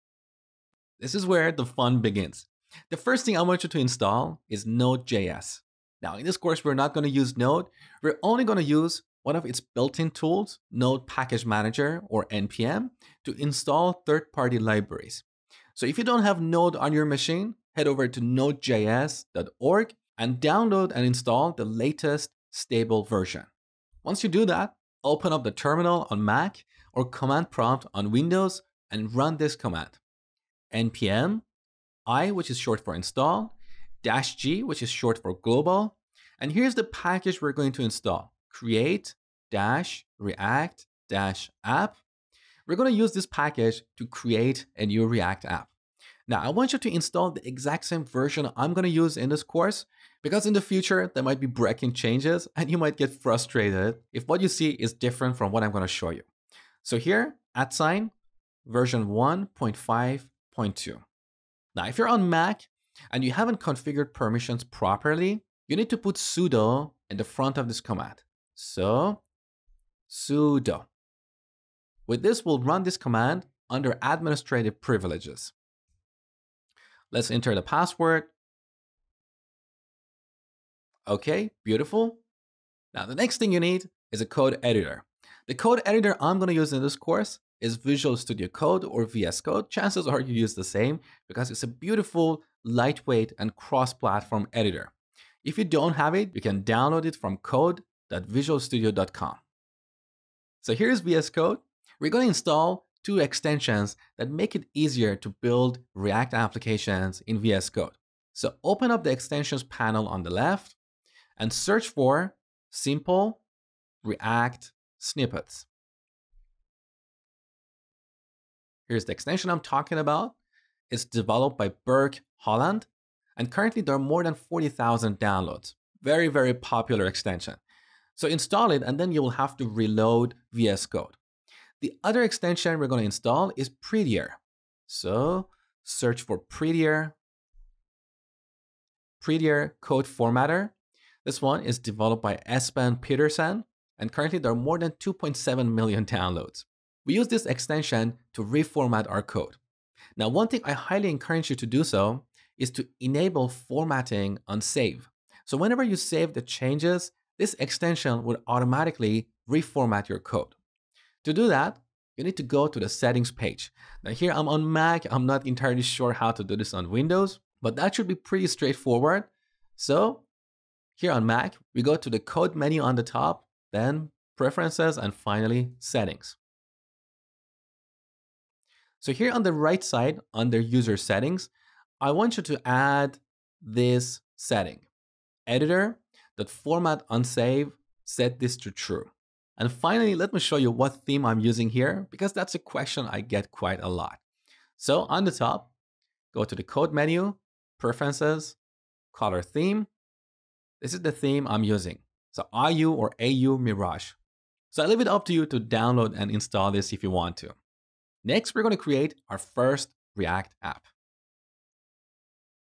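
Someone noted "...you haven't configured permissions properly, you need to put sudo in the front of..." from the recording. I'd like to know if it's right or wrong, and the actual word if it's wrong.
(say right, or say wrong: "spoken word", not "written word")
right.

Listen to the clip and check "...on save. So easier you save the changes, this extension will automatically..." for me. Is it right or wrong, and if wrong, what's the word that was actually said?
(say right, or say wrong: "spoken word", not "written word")
wrong: "whenever", not "easier".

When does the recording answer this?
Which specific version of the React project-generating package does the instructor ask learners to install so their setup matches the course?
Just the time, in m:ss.
0:59.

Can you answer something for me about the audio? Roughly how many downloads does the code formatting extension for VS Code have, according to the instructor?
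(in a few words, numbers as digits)
2.7 million.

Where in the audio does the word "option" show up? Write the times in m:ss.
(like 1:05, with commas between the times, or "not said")
not said.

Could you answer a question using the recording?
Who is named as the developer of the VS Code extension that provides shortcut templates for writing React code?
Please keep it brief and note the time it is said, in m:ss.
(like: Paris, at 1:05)
Burke Holland, at 2:01.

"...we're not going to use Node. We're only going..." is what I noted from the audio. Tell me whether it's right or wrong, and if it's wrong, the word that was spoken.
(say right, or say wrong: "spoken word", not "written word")
right.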